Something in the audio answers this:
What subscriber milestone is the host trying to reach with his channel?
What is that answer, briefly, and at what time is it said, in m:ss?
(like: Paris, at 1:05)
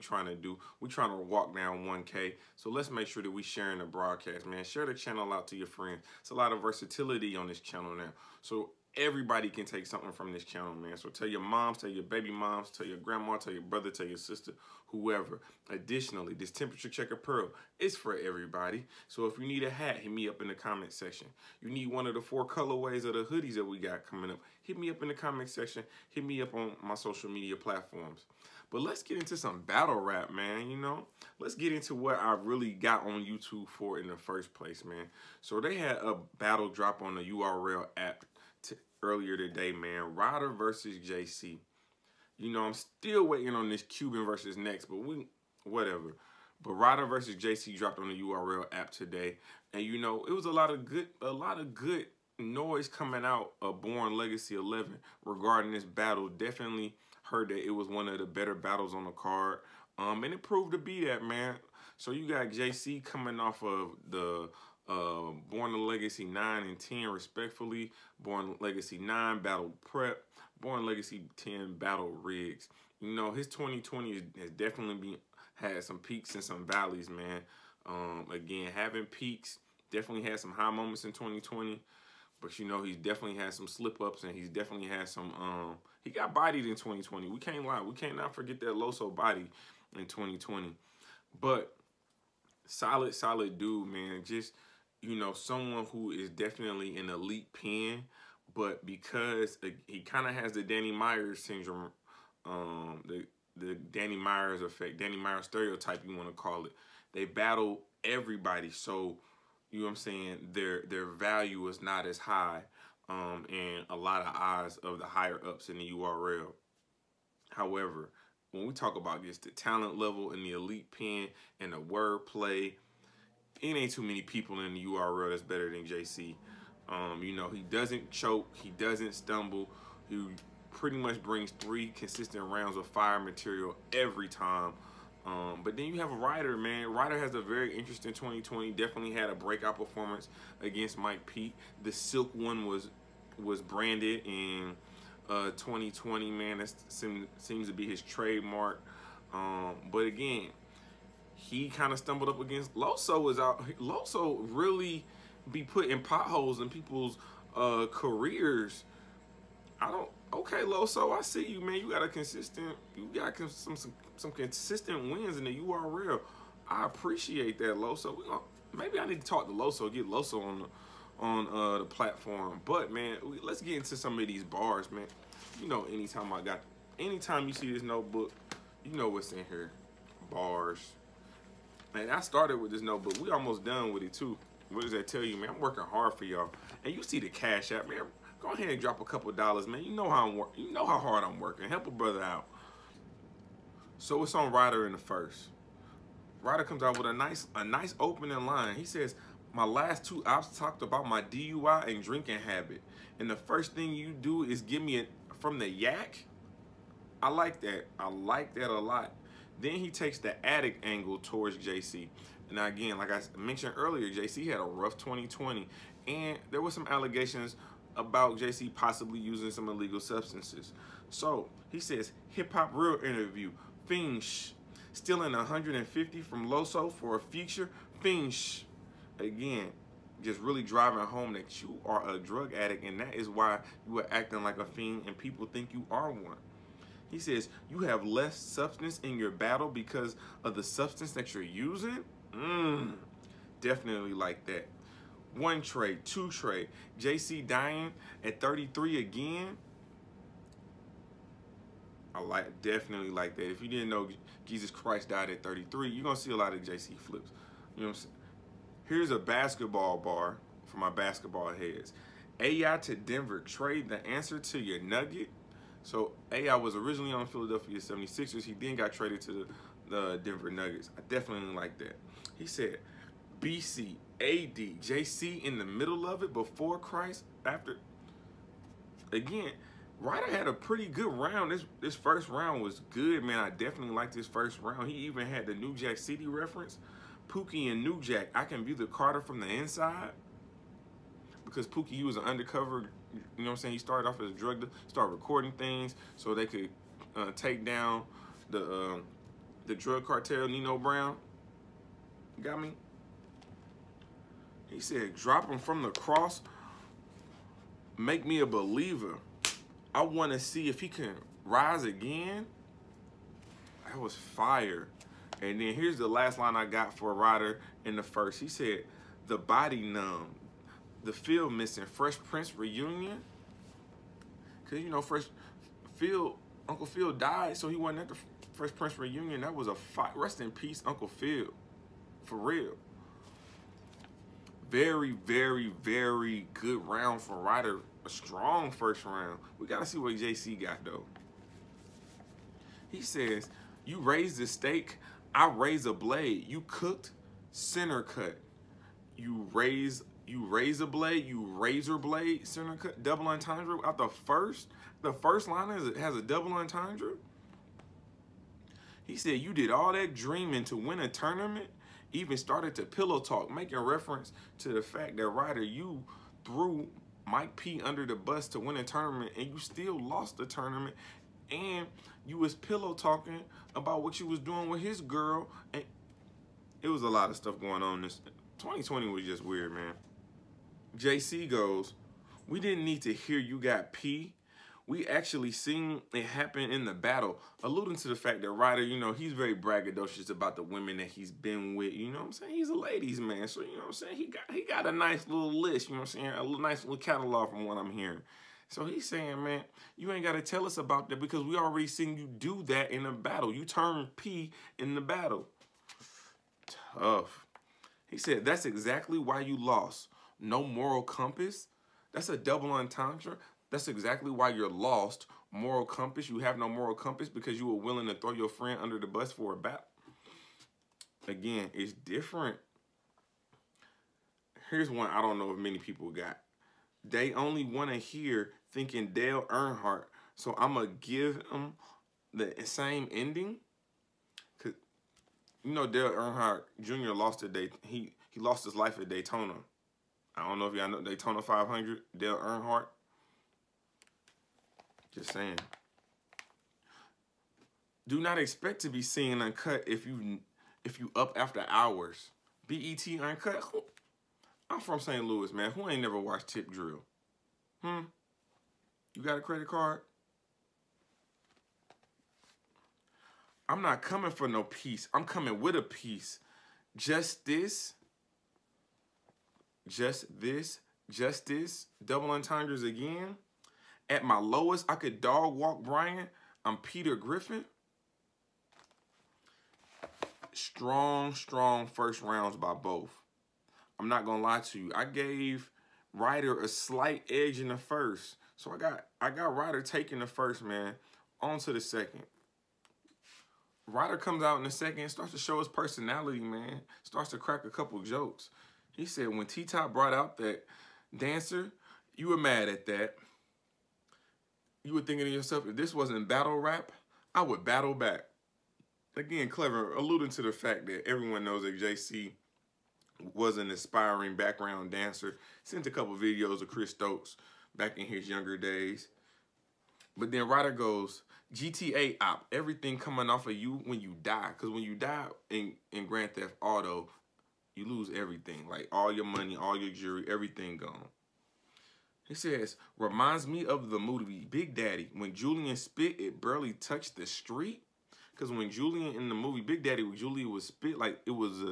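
1K, at 0:01.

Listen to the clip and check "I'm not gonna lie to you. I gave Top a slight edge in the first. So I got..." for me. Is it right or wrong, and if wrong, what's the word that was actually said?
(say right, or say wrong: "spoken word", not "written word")
wrong: "Ryda", not "Top".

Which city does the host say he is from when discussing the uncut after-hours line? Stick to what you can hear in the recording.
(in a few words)
St. Louis.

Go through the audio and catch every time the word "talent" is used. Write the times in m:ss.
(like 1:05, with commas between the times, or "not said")
1:59.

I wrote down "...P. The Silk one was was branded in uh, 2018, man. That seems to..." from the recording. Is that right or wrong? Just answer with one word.
wrong.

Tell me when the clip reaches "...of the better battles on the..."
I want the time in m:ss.
0:58.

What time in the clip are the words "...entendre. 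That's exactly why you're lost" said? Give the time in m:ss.
6:52.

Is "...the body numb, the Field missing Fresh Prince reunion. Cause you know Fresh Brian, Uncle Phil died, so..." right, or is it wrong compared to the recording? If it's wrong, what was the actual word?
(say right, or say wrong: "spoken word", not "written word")
wrong: "Field", not "Brian".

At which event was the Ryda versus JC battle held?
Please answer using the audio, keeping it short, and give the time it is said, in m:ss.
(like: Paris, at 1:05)
Born Legacy 11, at 0:53.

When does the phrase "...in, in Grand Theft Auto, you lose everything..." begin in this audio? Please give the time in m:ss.
8:45.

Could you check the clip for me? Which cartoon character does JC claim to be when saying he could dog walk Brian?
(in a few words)
Peter Griffin.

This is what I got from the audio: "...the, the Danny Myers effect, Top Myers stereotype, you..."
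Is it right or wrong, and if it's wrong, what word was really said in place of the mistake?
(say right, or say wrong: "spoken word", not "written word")
wrong: "Danny", not "Top".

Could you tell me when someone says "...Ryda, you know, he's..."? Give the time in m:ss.
6:28.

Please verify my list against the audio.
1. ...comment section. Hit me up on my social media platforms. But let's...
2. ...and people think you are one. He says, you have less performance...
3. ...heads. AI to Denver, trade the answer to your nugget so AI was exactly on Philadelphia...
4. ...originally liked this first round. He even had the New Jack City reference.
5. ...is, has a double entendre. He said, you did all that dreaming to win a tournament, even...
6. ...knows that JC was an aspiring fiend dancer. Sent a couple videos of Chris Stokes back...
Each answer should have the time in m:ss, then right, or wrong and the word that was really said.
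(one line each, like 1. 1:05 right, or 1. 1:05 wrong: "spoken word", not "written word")
1. 0:25 right
2. 3:55 wrong: "substance", not "performance"
3. 4:21 wrong: "originally", not "exactly"
4. 4:43 wrong: "definitely", not "originally"
5. 5:55 right
6. 8:31 wrong: "background", not "fiend".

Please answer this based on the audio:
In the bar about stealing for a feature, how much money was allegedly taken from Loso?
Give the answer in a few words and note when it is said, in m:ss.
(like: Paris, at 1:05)
150, at 3:45.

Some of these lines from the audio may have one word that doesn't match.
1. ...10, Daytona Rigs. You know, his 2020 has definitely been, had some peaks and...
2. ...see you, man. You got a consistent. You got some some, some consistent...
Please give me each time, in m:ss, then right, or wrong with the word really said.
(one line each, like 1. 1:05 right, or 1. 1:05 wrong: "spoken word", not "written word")
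1. 1:11 wrong: "Battle", not "Daytona"
2. 2:41 right.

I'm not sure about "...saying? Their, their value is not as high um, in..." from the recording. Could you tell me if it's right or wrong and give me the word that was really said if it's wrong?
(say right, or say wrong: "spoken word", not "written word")
right.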